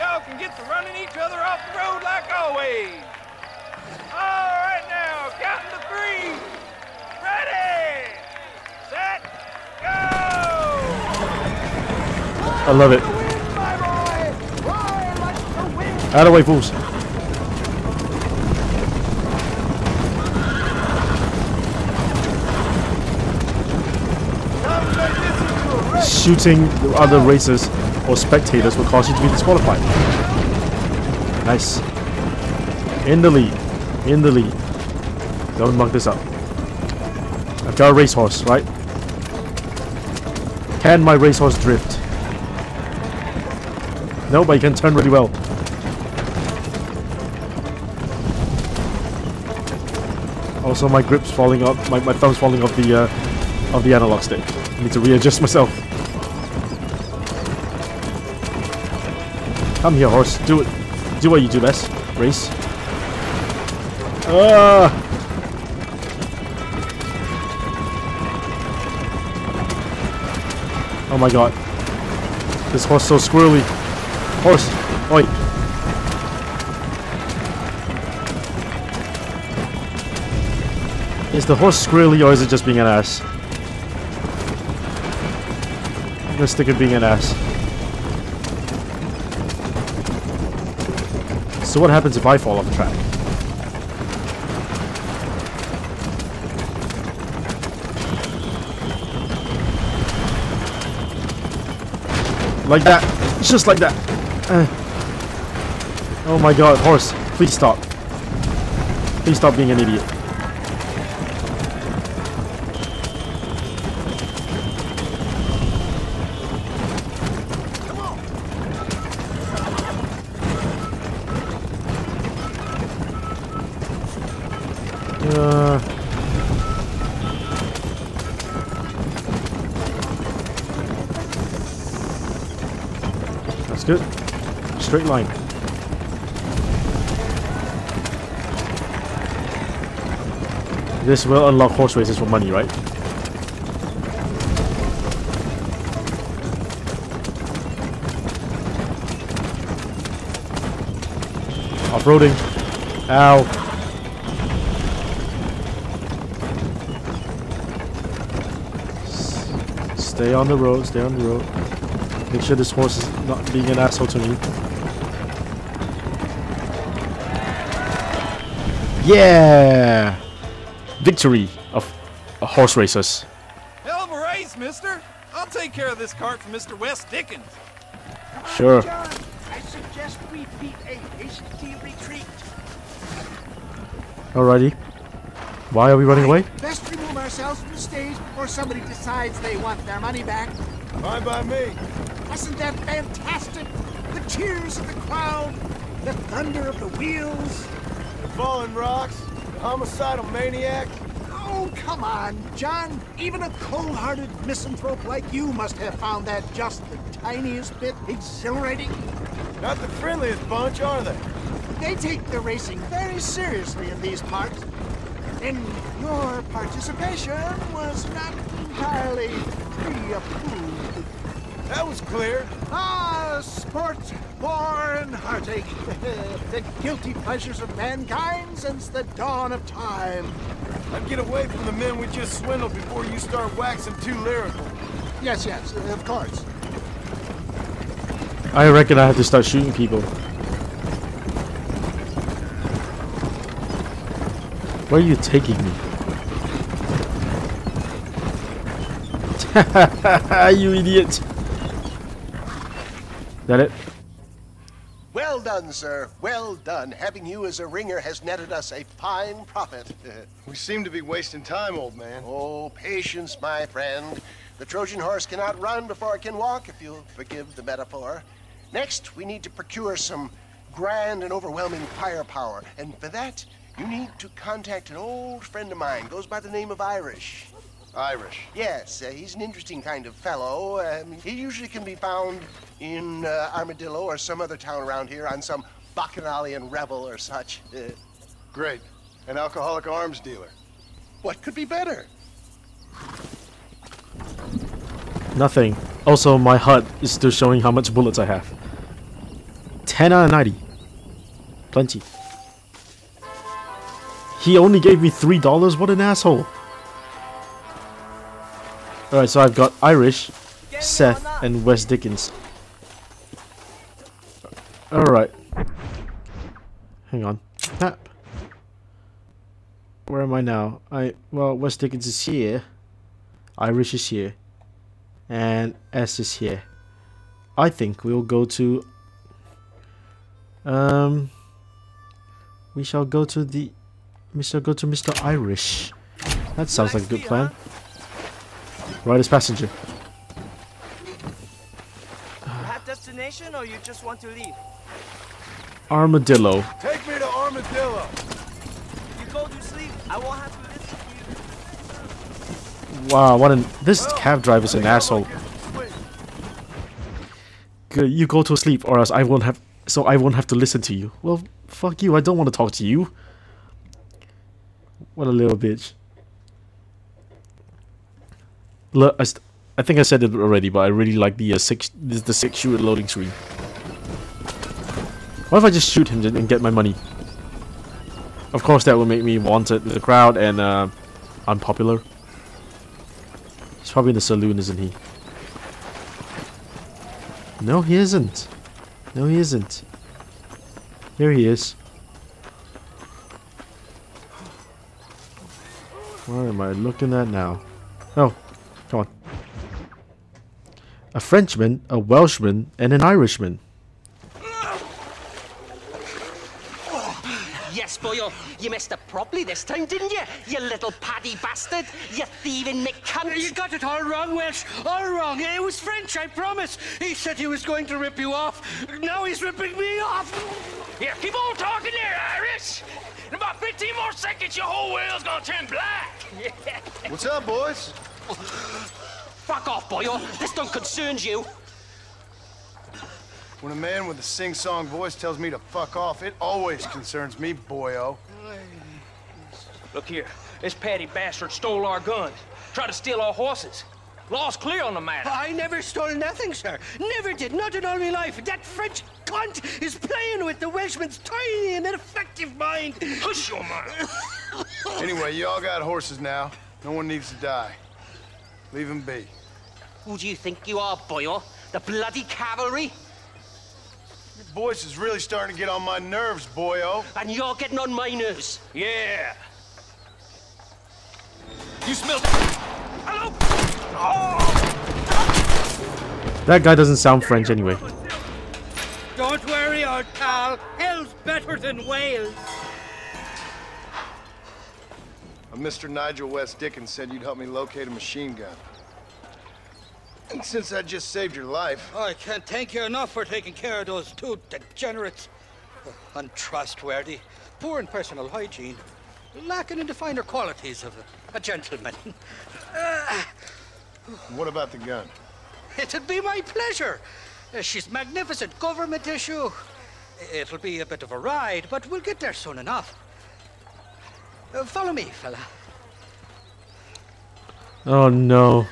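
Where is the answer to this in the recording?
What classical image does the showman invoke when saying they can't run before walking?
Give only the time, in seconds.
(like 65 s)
264 s.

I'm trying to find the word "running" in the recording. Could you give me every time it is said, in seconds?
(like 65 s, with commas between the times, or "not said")
0 s, 186 s.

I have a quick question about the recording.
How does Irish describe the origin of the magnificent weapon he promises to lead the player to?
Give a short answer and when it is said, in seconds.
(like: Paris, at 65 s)
government issue, at 508 s.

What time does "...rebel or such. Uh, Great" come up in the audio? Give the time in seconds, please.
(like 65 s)
286 s.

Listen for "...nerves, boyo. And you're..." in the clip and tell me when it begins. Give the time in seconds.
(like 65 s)
466 s.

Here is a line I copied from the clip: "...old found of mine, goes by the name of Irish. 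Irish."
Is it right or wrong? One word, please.
wrong.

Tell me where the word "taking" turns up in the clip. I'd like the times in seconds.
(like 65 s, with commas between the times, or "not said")
245 s, 493 s.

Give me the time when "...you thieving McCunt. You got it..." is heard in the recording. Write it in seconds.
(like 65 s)
412 s.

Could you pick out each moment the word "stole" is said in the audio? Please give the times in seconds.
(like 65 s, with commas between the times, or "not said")
441 s, 445 s.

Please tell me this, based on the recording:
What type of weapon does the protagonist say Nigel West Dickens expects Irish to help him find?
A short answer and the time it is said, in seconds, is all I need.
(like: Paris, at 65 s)
machine gun, at 487 s.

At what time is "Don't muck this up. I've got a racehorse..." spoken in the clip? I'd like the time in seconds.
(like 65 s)
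35 s.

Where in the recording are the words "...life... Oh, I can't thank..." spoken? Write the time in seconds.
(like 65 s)
491 s.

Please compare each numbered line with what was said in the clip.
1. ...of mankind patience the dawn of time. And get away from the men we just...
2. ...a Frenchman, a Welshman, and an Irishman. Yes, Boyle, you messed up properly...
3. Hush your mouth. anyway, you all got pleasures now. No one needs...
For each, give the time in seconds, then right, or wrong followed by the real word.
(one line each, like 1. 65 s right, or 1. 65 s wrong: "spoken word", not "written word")
1. 227 s wrong: "since", not "patience"
2. 401 s right
3. 453 s wrong: "horses", not "pleasures".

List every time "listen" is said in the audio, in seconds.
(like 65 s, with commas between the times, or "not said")
350 s, 360 s.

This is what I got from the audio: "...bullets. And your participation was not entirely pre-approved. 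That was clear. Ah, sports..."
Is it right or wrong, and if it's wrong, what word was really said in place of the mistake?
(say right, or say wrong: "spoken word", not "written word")
wrong: "parts", not "bullets".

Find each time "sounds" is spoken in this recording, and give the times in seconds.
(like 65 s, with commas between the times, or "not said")
336 s, 476 s.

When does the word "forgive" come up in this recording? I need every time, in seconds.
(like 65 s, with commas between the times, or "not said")
267 s.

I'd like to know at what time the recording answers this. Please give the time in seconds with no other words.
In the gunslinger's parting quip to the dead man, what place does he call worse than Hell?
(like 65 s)
481 s.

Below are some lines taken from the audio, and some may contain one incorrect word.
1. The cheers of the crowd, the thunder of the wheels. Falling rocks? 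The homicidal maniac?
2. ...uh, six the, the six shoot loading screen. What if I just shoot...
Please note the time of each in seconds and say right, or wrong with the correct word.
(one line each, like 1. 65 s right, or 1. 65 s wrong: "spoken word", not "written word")
1. 194 s right
2. 371 s right.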